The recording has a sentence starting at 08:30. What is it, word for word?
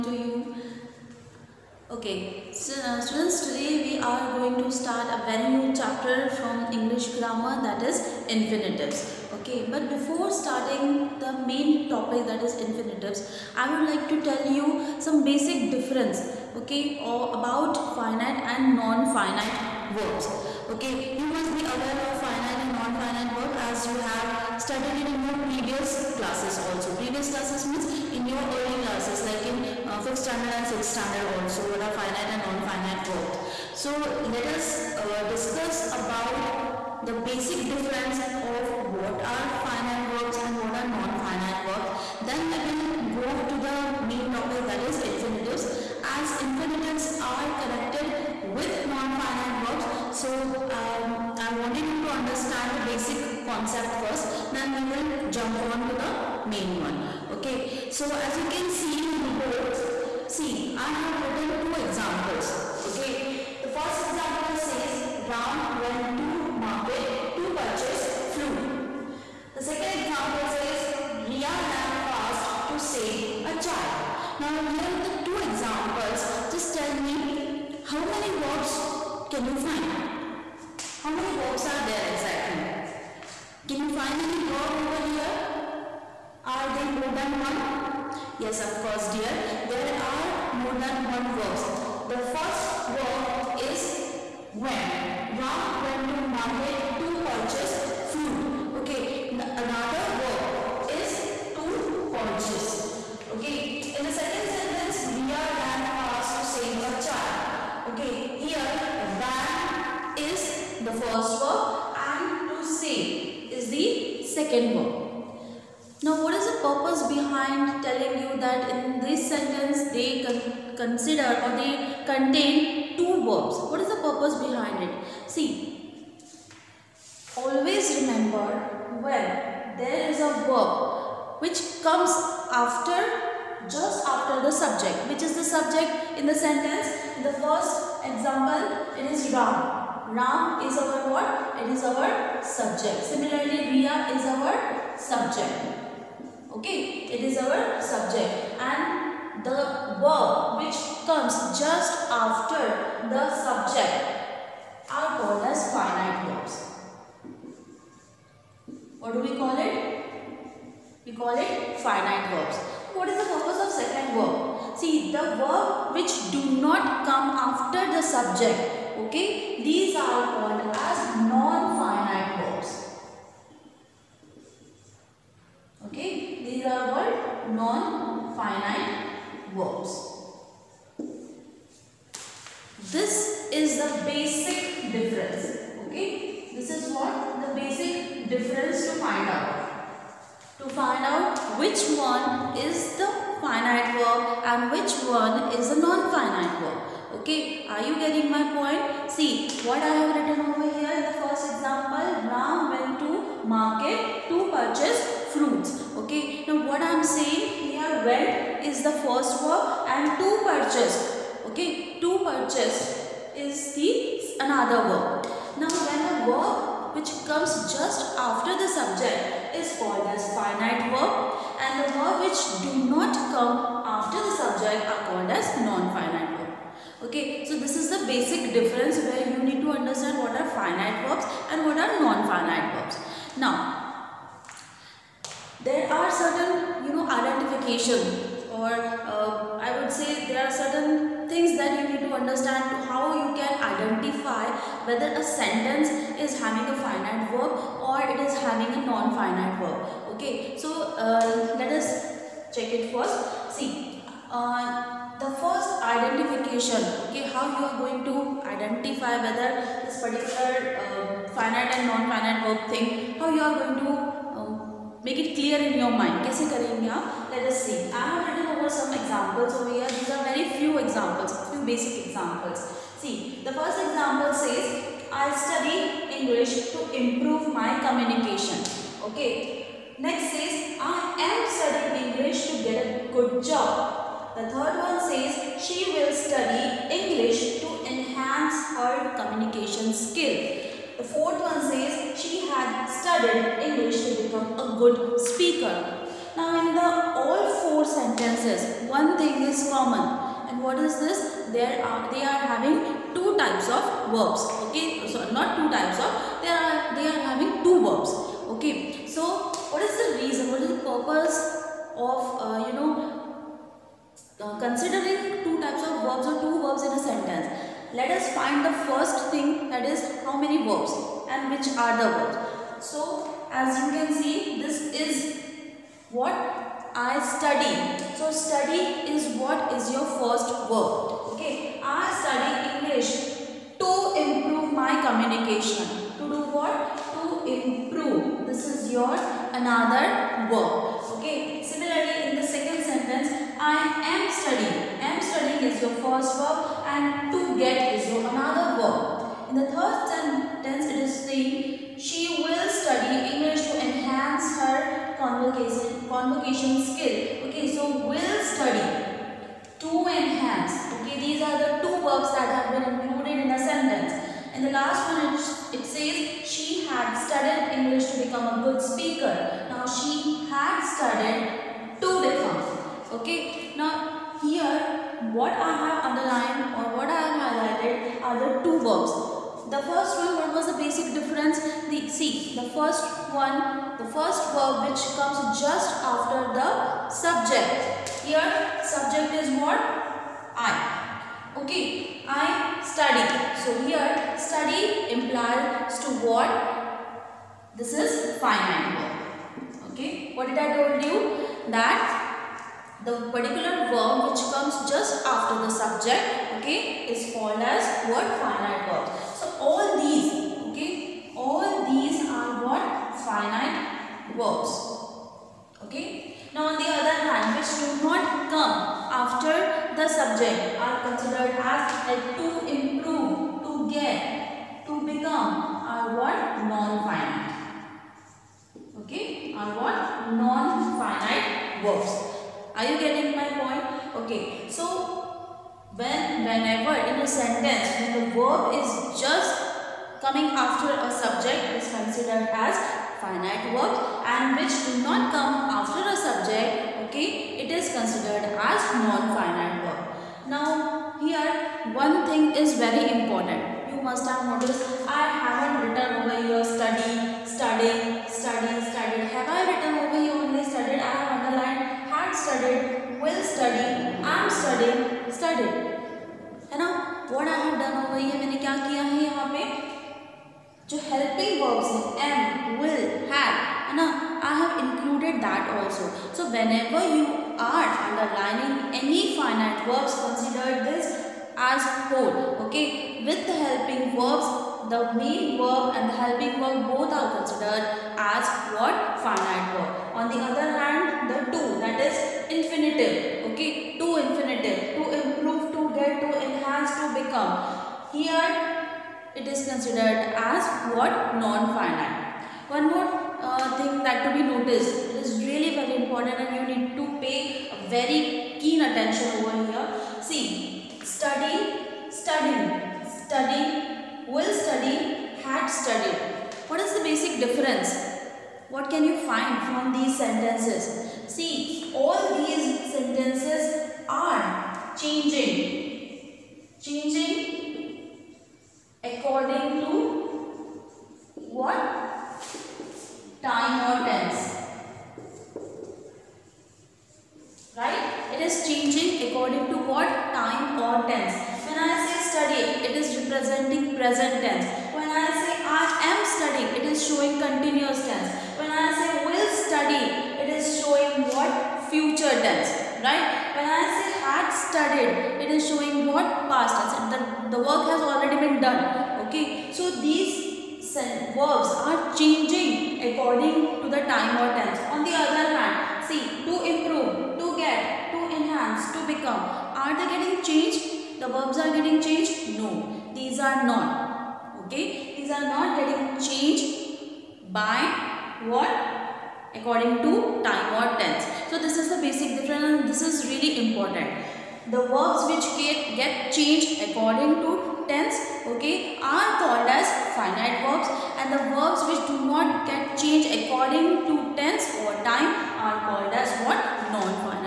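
See, study, study, study, will study, had studied.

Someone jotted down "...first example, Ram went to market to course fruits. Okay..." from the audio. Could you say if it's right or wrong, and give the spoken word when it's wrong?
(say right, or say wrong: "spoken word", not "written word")
wrong: "purchase", not "course".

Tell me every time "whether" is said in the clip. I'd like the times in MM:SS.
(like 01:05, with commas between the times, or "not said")
04:04, 04:19.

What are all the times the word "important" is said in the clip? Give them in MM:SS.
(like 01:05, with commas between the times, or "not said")
07:33, 08:26, 09:43.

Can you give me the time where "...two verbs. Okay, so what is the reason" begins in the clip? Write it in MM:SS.
05:07.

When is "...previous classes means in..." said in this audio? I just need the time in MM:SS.
00:26.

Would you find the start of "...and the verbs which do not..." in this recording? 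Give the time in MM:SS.
09:51.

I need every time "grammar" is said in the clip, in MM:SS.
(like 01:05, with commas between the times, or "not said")
00:07.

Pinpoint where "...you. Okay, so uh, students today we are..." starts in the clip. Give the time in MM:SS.
00:00.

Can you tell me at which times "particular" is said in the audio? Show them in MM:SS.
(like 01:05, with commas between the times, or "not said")
04:20, 06:43.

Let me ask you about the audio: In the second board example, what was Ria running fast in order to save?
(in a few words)
a child.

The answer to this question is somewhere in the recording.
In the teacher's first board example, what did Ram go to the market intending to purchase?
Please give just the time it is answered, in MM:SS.
01:08.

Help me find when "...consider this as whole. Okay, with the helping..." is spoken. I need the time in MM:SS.
08:00.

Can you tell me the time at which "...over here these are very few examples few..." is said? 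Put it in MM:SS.
04:29.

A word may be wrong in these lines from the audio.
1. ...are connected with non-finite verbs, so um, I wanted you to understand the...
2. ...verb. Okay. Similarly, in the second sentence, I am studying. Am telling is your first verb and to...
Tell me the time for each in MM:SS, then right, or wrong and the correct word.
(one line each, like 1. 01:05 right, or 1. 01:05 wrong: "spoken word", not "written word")
1. 00:47 right
2. 05:40 wrong: "studying", not "telling".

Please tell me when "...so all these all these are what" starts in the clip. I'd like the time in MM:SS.
06:49.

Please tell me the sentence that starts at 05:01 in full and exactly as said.
There are they are having two types of verbs.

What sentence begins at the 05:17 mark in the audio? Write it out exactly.
Let us find the first thing that is how many verbs and which are the verbs.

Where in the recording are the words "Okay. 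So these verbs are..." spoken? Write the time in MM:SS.
09:19.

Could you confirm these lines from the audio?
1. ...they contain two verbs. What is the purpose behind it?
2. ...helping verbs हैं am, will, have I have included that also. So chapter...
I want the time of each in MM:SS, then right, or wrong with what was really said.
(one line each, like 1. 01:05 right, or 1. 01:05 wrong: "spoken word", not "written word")
1. 02:01 right
2. 07:51 wrong: "whenever", not "chapter".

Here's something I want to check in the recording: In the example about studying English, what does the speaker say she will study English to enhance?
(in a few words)
her communication skill.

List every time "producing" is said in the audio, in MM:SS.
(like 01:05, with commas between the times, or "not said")
not said.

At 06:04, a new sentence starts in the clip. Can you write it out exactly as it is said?
In the last one, it, it says she had studied English to become a good speaker.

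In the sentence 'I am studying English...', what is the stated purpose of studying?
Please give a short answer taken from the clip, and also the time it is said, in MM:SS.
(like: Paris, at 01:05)
to get a good job, at 04:42.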